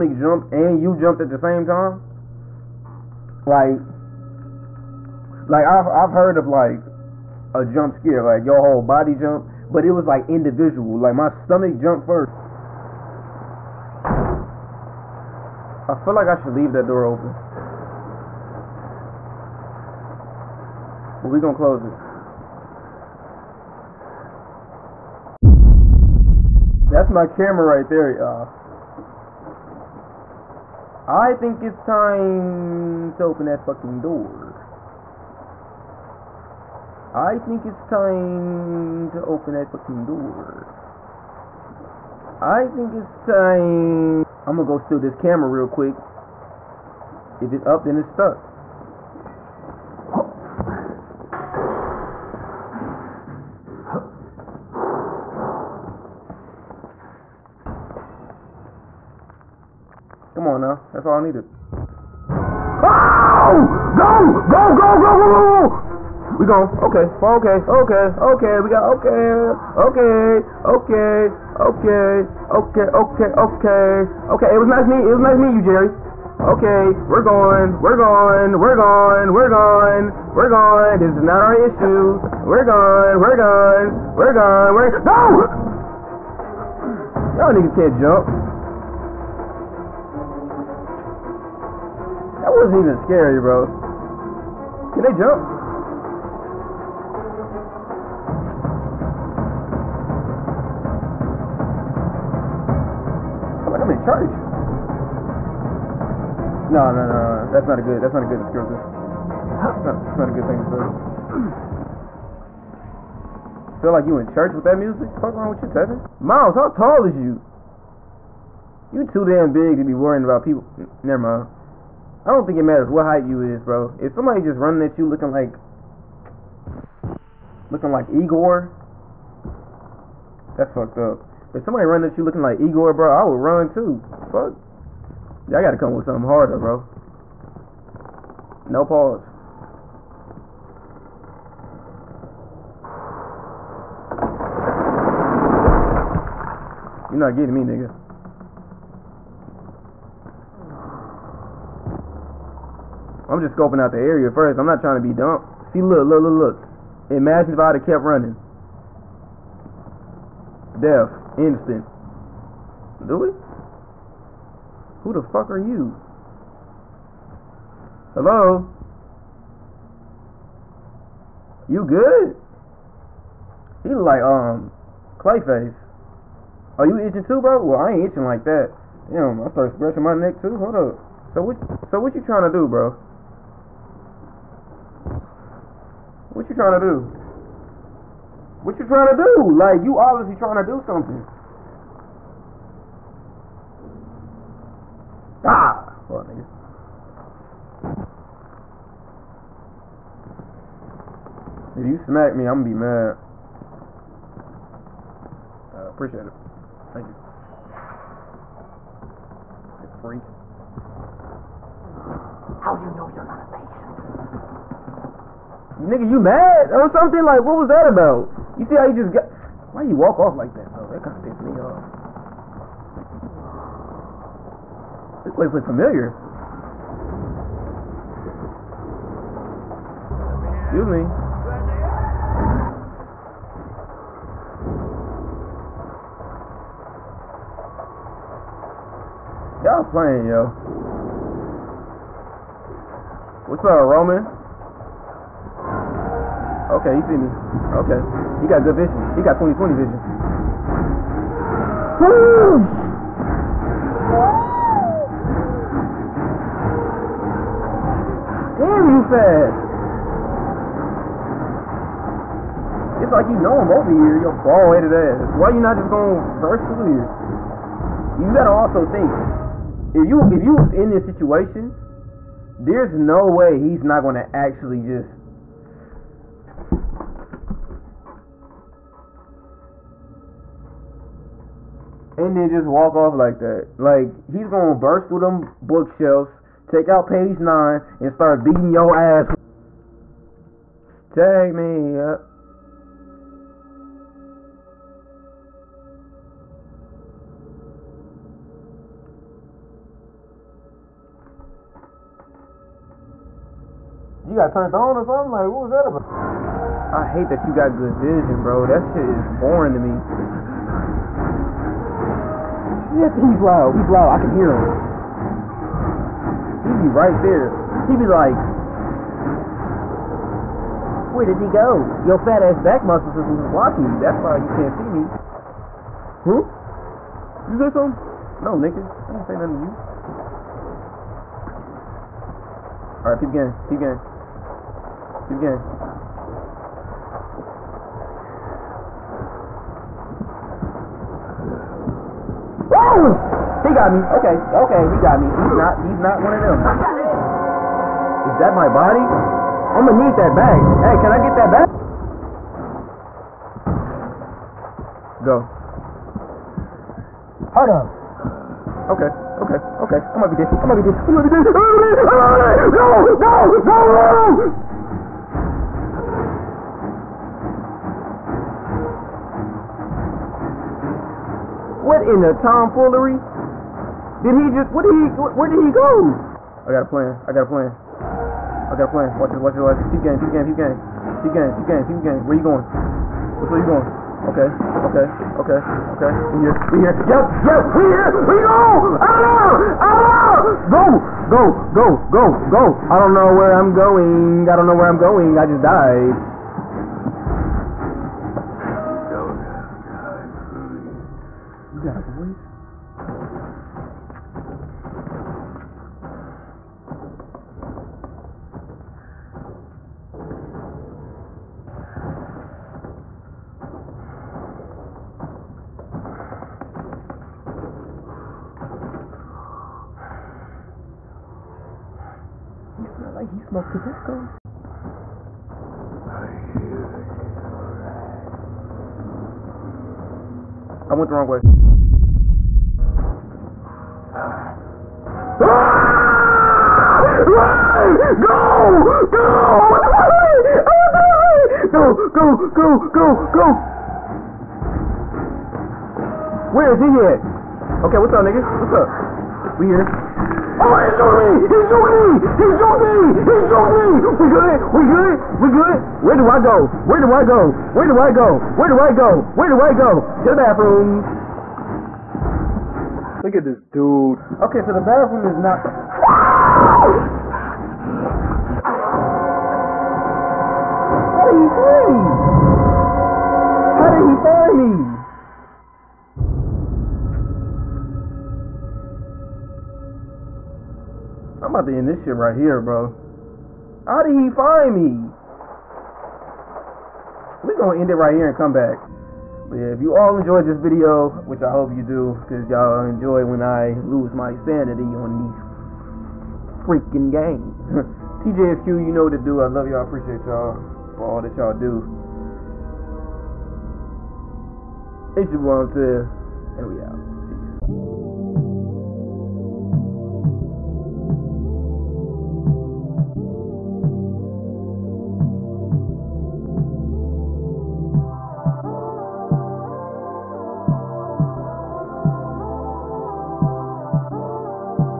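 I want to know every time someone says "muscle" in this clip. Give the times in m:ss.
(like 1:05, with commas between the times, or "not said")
5:22.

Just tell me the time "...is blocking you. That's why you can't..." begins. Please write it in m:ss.
5:23.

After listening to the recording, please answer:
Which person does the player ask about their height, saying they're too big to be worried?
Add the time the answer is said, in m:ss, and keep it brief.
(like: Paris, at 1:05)
Miles, at 1:56.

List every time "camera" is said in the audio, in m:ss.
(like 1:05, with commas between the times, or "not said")
0:27, 0:45.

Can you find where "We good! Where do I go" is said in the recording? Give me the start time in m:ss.
7:35.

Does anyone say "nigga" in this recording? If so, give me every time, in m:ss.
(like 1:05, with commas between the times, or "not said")
1:27, 2:27, 3:16, 3:35, 5:28, 7:28.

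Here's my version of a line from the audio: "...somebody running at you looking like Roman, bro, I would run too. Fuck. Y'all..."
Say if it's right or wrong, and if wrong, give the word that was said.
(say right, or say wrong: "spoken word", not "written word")
wrong: "Igor", not "Roman".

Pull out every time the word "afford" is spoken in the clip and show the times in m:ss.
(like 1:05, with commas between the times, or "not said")
not said.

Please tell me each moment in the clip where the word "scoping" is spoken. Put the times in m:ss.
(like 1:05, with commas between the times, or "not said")
2:33.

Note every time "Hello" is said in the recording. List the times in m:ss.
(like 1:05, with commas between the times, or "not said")
2:48.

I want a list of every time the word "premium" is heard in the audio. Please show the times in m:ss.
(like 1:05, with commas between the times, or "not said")
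not said.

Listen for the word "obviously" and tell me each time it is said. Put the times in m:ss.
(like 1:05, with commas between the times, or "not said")
3:09.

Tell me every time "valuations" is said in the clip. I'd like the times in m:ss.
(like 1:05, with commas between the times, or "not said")
not said.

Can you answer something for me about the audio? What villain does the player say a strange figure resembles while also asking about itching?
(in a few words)
Clayface.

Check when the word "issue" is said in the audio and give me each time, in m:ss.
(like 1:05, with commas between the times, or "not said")
1:21.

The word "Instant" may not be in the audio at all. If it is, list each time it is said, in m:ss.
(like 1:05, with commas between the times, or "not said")
2:41.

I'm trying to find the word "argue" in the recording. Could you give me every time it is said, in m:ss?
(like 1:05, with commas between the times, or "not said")
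not said.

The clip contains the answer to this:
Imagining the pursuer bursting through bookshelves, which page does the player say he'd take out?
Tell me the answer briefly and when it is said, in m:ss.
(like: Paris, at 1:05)
page nine, at 4:47.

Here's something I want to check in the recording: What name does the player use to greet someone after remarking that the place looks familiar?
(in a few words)
Roman.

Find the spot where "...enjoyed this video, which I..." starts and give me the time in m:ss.
8:10.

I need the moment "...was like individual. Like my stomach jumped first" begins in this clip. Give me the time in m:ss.
0:09.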